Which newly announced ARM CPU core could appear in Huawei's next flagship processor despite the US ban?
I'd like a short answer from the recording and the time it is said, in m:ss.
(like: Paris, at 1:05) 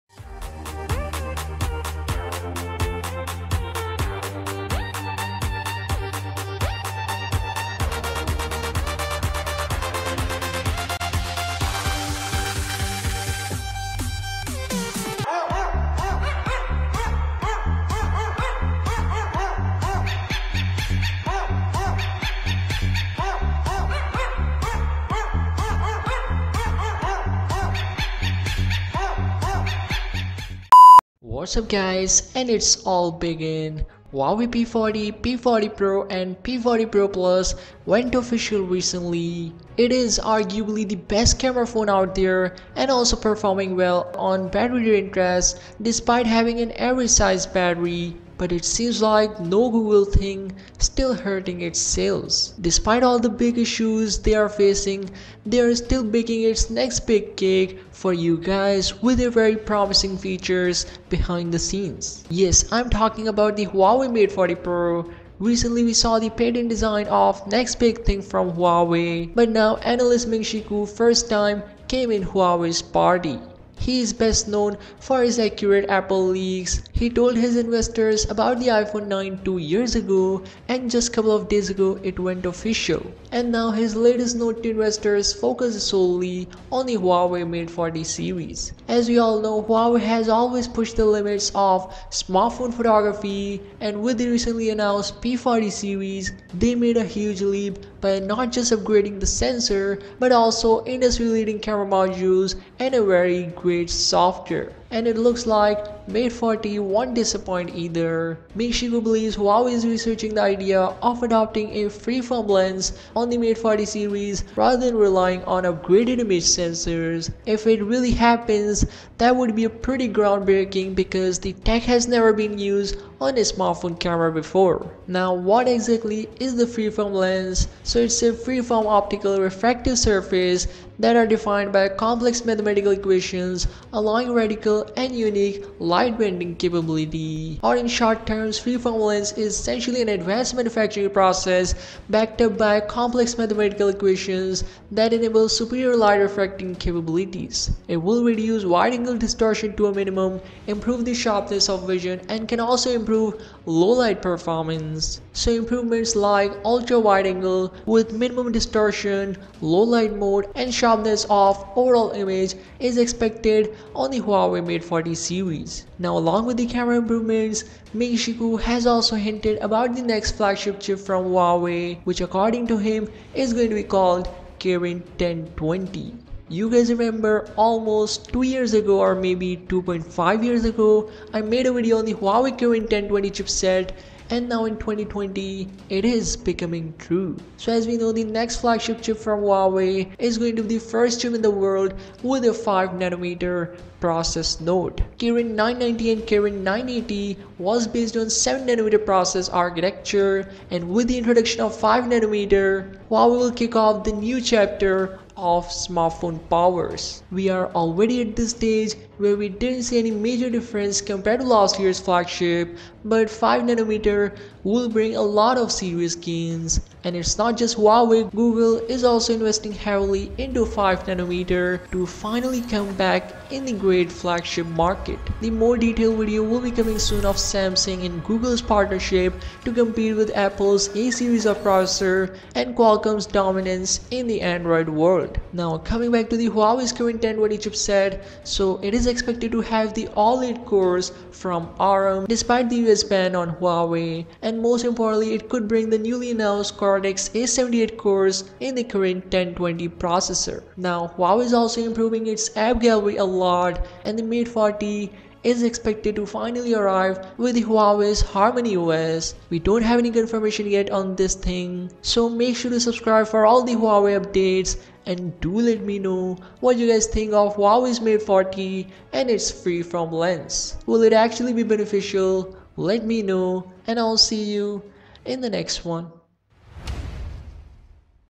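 Cortex A78, at 4:06.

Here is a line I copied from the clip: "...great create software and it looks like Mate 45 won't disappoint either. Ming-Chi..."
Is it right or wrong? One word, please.
wrong.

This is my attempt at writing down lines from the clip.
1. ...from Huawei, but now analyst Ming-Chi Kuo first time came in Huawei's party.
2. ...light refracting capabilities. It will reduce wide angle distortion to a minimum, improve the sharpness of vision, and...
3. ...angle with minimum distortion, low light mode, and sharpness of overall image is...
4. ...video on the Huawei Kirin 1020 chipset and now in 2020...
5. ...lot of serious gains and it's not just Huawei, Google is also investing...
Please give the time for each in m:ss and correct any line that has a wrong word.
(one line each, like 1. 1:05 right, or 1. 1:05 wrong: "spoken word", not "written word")
1. 1:08 right
2. 2:25 right
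3. 2:37 right
4. 3:01 right
5. 3:35 right.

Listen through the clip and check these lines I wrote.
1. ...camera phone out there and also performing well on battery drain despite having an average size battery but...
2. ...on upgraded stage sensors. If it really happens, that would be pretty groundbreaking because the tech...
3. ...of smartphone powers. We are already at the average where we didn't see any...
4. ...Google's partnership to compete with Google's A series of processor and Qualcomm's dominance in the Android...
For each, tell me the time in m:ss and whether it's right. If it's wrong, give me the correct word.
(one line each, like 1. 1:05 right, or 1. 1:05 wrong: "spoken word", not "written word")
1. 0:41 right
2. 1:55 wrong: "image", not "stage"
3. 3:25 wrong: "stage", not "average"
4. 3:48 wrong: "Apple", not "Google".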